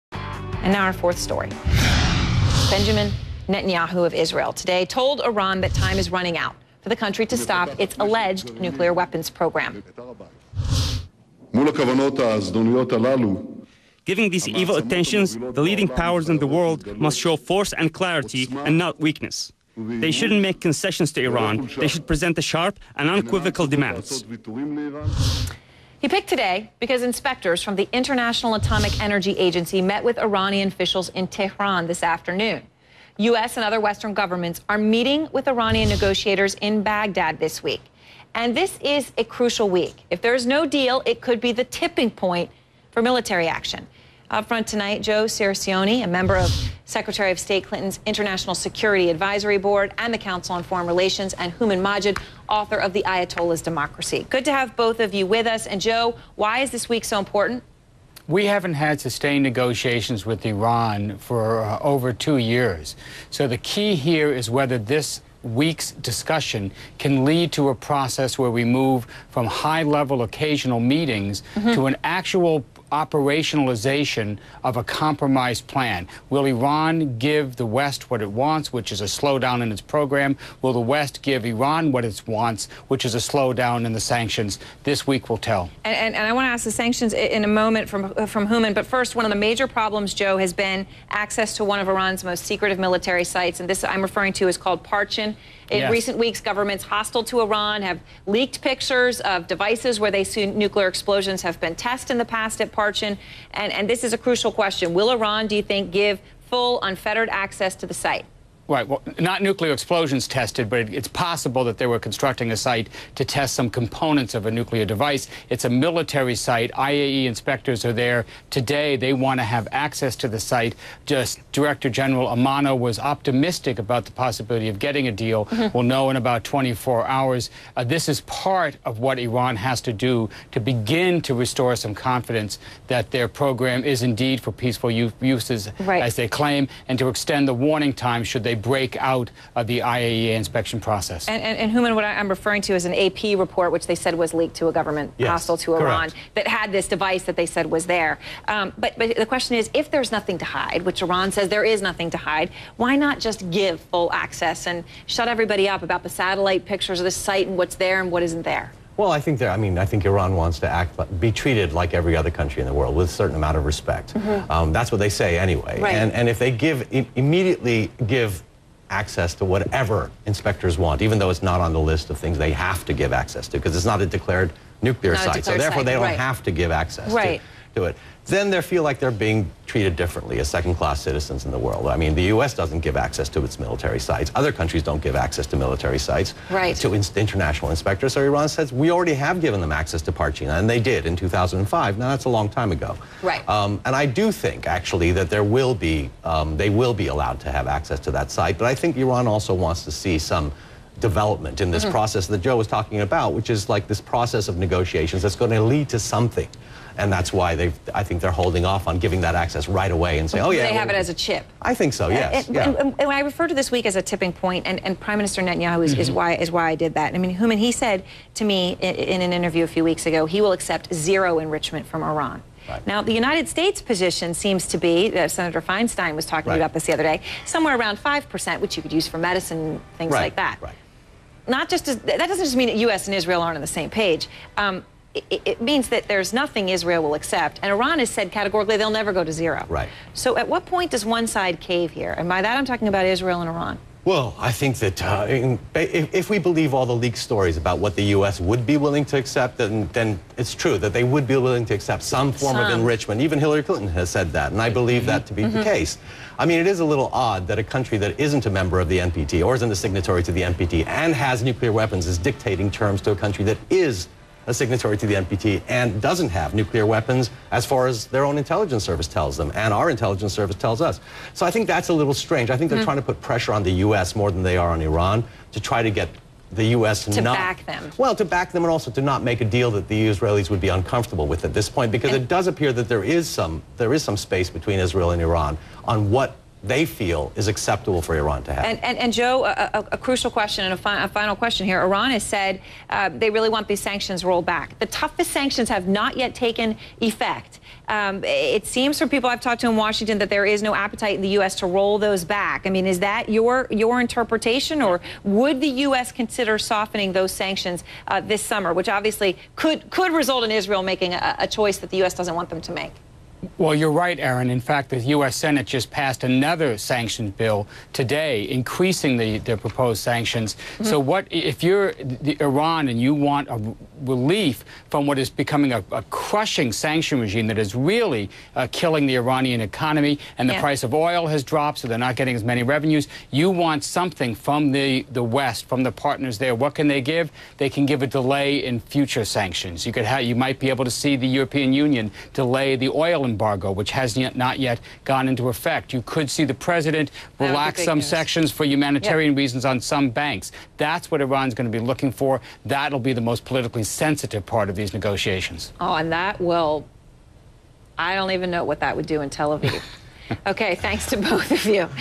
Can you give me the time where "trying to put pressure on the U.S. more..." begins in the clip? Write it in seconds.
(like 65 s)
272 s.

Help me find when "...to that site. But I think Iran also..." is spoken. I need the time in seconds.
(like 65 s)
198 s.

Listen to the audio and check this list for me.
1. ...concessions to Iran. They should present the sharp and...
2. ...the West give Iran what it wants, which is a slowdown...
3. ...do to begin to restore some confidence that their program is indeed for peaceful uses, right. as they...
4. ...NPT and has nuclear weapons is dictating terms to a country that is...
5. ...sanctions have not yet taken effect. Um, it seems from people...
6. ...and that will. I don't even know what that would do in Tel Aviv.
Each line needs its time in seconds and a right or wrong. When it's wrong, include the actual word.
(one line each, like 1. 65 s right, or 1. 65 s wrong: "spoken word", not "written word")
1. 20 s right
2. 80 s right
3. 130 s right
4. 260 s right
5. 295 s right
6. 355 s right.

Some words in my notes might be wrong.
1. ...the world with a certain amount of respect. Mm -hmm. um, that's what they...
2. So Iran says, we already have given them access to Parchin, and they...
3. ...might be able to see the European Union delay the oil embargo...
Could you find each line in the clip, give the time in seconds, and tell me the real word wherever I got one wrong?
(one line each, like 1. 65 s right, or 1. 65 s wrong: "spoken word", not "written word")
1. 162 s right
2. 188 s right
3. 340 s right.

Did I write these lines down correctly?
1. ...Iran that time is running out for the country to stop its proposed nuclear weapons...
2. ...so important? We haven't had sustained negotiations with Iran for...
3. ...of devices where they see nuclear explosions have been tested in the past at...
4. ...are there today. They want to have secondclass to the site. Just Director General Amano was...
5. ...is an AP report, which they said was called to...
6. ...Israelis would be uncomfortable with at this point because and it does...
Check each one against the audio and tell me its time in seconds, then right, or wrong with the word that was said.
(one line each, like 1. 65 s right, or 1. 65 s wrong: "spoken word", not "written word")
1. 5 s wrong: "alleged", not "proposed"
2. 57 s right
3. 99 s right
4. 117 s wrong: "access", not "secondclass"
5. 142 s wrong: "leaked", not "called"
6. 280 s right.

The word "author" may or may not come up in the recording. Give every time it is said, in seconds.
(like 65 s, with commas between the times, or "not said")
52 s.